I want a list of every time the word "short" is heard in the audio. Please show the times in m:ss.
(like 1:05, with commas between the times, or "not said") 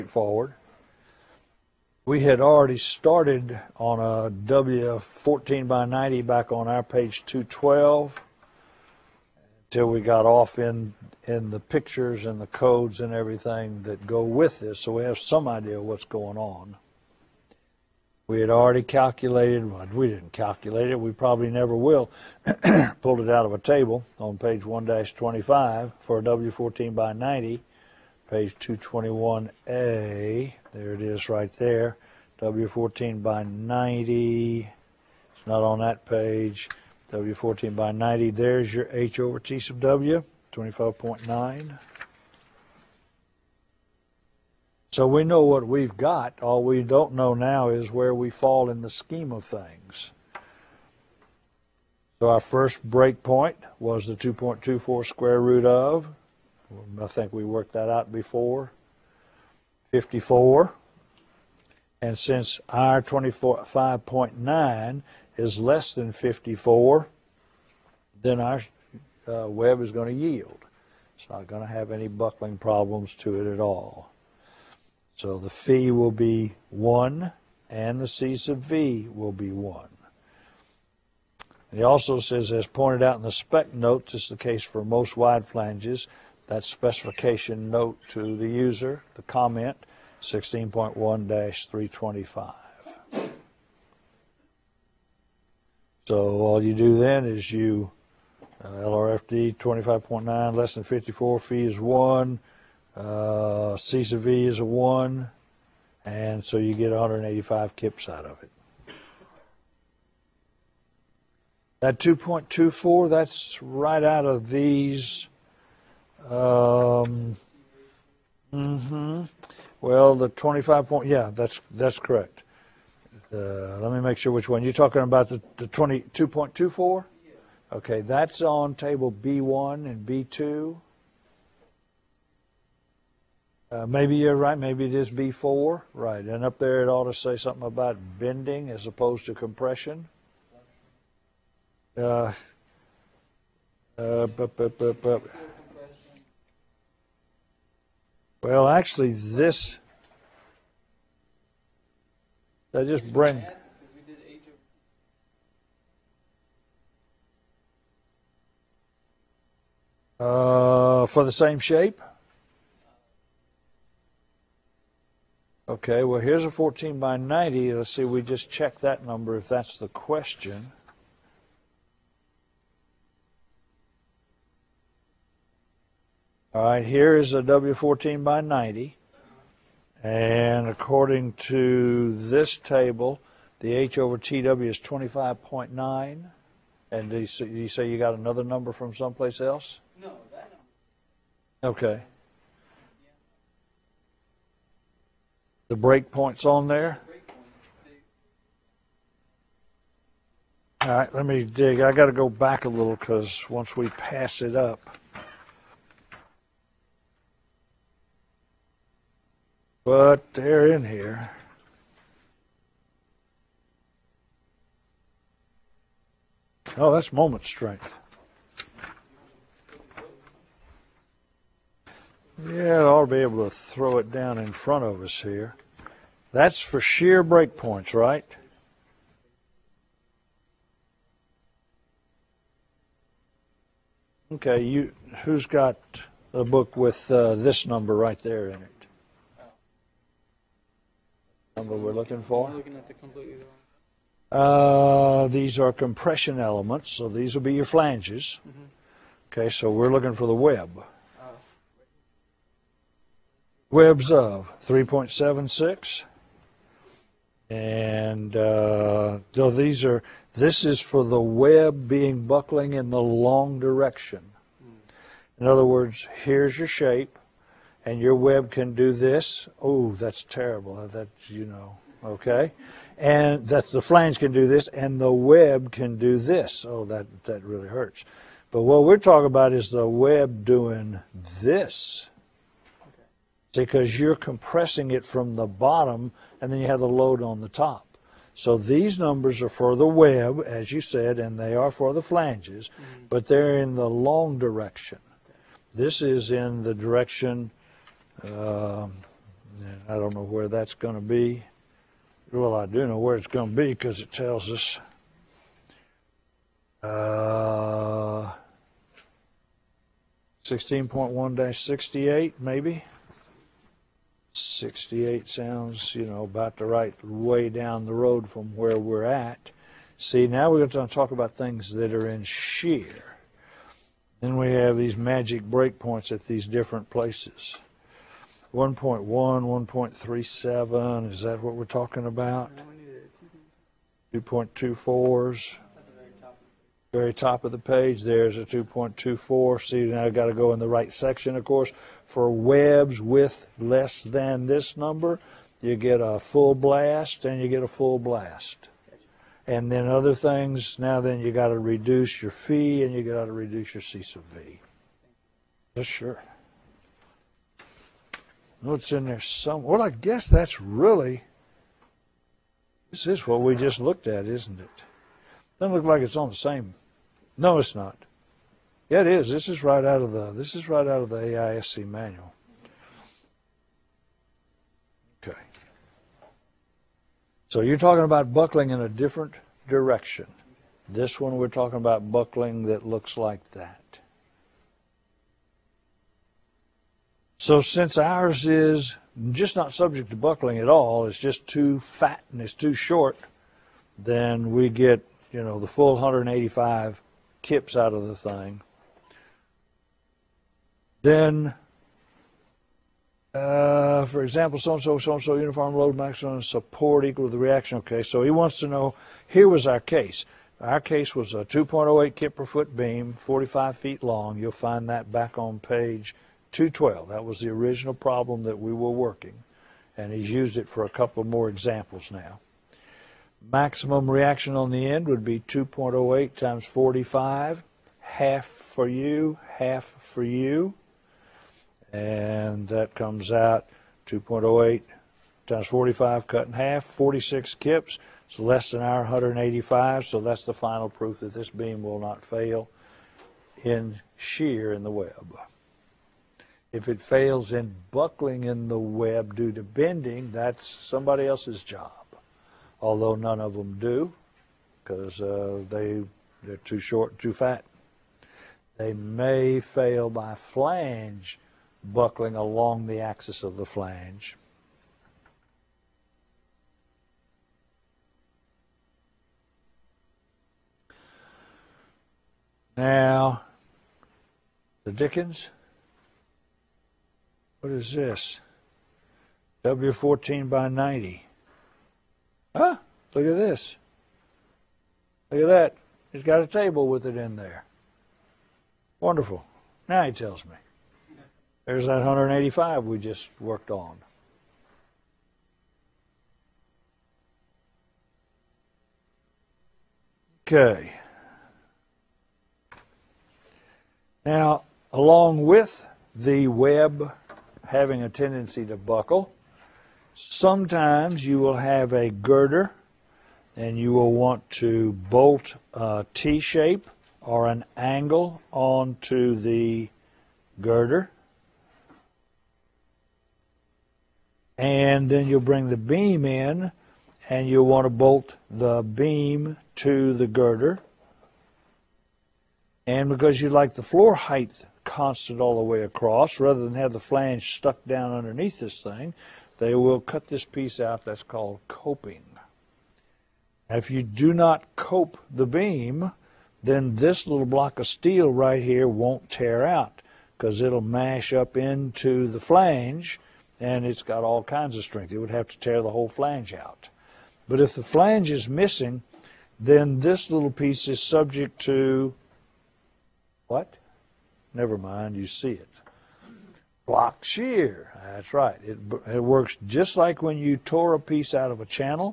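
6:32, 7:36.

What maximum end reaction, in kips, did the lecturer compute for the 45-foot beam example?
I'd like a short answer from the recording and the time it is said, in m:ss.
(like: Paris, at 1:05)
46 kips, at 7:16.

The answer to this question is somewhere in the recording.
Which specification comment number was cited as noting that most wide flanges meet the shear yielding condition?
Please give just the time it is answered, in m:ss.
1:30.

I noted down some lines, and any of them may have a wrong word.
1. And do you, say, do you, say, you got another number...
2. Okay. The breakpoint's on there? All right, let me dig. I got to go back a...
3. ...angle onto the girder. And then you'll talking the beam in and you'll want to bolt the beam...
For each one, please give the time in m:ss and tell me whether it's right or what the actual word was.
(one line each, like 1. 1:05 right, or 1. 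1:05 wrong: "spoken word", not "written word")
1. 3:06 right
2. 3:11 right
3. 8:37 wrong: "bring", not "talking".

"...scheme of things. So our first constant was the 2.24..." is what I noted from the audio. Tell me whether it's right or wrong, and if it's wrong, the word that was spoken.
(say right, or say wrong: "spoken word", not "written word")
wrong: "breakpoint", not "constant".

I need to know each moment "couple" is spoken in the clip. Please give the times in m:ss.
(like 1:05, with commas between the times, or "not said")
7:00.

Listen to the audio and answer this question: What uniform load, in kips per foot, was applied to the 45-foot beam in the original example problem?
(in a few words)
2.08 kips per foot.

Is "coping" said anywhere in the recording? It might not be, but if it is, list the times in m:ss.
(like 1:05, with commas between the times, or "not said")
9:01.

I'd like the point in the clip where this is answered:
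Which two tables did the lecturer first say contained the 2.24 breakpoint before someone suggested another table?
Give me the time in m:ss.
2:08.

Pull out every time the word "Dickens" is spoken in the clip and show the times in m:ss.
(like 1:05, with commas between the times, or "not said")
7:54.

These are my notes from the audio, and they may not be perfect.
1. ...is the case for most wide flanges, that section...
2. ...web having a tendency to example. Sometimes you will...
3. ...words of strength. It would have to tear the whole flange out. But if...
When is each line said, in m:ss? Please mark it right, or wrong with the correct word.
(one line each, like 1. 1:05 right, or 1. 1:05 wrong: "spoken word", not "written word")
1. 1:24 wrong: "specification", not "section"
2. 8:26 wrong: "buckle", not "example"
3. 9:14 wrong: "kinds", not "words".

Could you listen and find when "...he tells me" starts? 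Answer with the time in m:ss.
8:10.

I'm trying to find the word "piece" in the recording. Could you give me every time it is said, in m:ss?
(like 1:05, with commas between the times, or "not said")
9:00, 9:20, 9:31.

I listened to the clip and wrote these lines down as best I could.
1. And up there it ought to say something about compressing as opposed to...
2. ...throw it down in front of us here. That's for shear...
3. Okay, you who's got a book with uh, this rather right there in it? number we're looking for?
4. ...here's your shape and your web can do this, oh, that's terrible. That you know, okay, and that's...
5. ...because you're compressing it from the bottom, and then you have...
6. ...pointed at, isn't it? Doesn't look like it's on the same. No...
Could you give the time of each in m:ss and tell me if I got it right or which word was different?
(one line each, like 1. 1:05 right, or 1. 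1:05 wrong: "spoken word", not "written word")
1. 2:16 wrong: "bending", not "compressing"
2. 3:43 right
3. 3:54 wrong: "number", not "rather"
4. 4:26 right
5. 4:43 right
6. 6:03 wrong: "looked", not "pointed".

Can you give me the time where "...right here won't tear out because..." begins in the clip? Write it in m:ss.
9:08.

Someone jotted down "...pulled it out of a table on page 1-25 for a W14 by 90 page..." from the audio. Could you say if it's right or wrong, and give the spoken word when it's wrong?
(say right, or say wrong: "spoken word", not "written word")
right.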